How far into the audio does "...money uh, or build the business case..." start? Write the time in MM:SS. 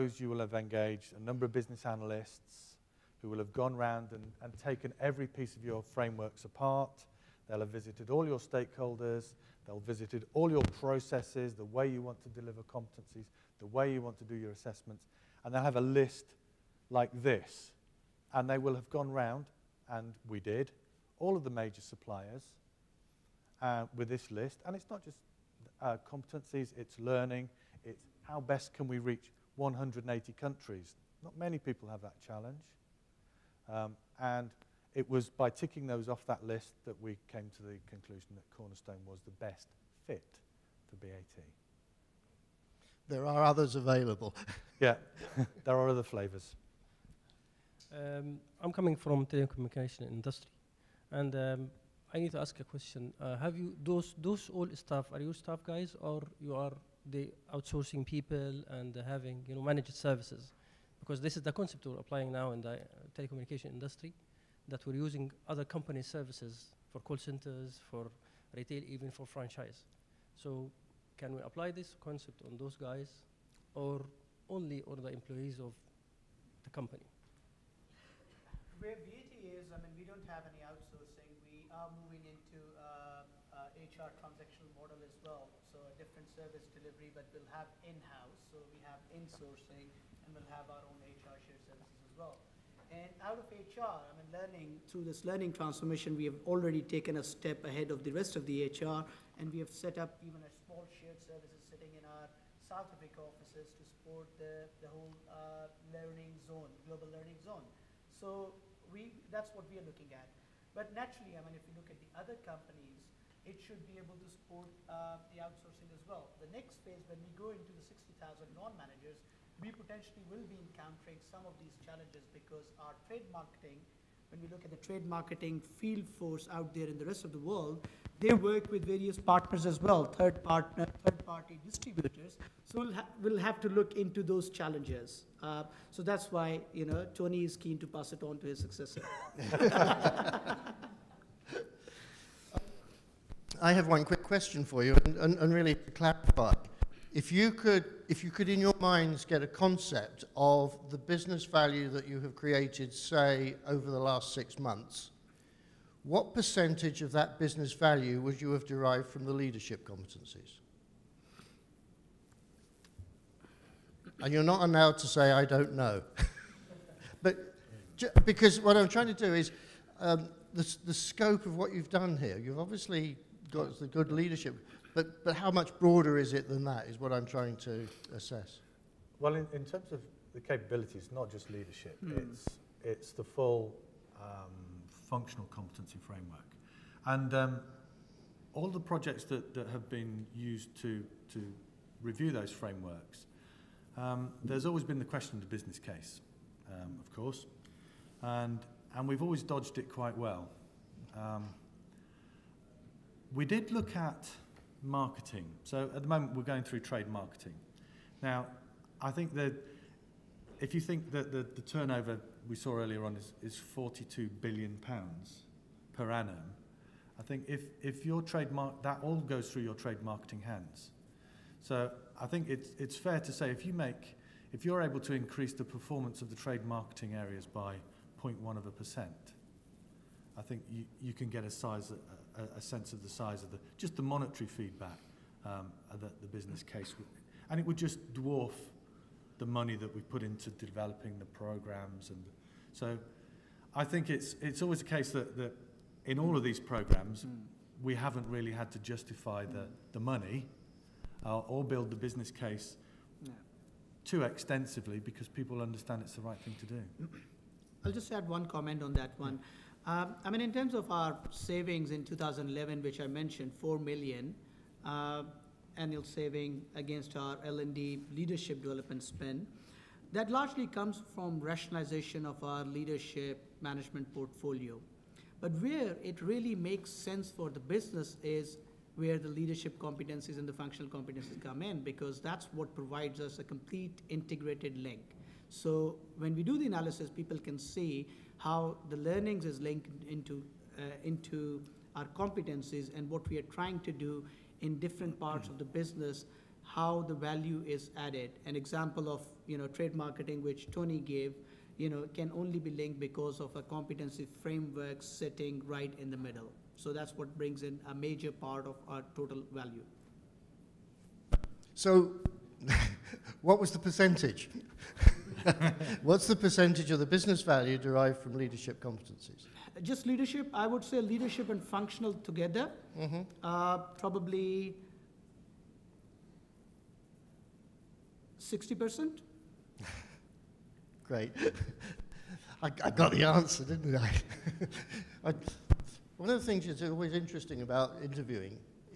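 04:09.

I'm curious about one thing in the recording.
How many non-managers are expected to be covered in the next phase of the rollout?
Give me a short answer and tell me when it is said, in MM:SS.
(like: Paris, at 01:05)
60,000, at 01:57.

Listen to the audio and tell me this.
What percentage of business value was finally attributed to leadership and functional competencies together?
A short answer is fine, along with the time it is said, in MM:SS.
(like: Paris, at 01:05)
60%, at 05:28.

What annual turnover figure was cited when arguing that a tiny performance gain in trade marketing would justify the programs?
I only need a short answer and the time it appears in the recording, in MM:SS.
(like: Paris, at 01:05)
42 billion pounds, at 03:33.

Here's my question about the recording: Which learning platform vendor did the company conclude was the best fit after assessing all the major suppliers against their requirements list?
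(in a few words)
Cornerstone.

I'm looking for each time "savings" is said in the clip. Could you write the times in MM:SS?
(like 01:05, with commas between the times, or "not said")
04:21, 04:26.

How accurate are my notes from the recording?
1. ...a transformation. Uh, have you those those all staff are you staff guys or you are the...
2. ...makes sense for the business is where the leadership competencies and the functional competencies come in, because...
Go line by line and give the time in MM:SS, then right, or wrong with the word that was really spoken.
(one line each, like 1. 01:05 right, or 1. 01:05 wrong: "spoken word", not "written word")
1. 00:52 wrong: "question", not "transformation"
2. 04:36 right.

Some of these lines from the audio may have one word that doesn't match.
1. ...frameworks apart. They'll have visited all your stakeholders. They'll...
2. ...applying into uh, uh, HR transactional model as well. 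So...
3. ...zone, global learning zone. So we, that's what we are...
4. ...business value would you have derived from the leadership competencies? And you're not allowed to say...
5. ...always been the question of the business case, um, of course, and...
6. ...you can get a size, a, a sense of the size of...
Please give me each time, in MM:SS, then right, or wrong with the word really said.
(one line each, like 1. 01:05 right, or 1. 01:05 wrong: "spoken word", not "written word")
1. 00:05 right
2. 01:22 wrong: "moving", not "applying"
3. 01:46 right
4. 02:37 right
5. 03:14 right
6. 03:50 right.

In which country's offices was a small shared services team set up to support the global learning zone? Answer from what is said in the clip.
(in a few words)
South Africa.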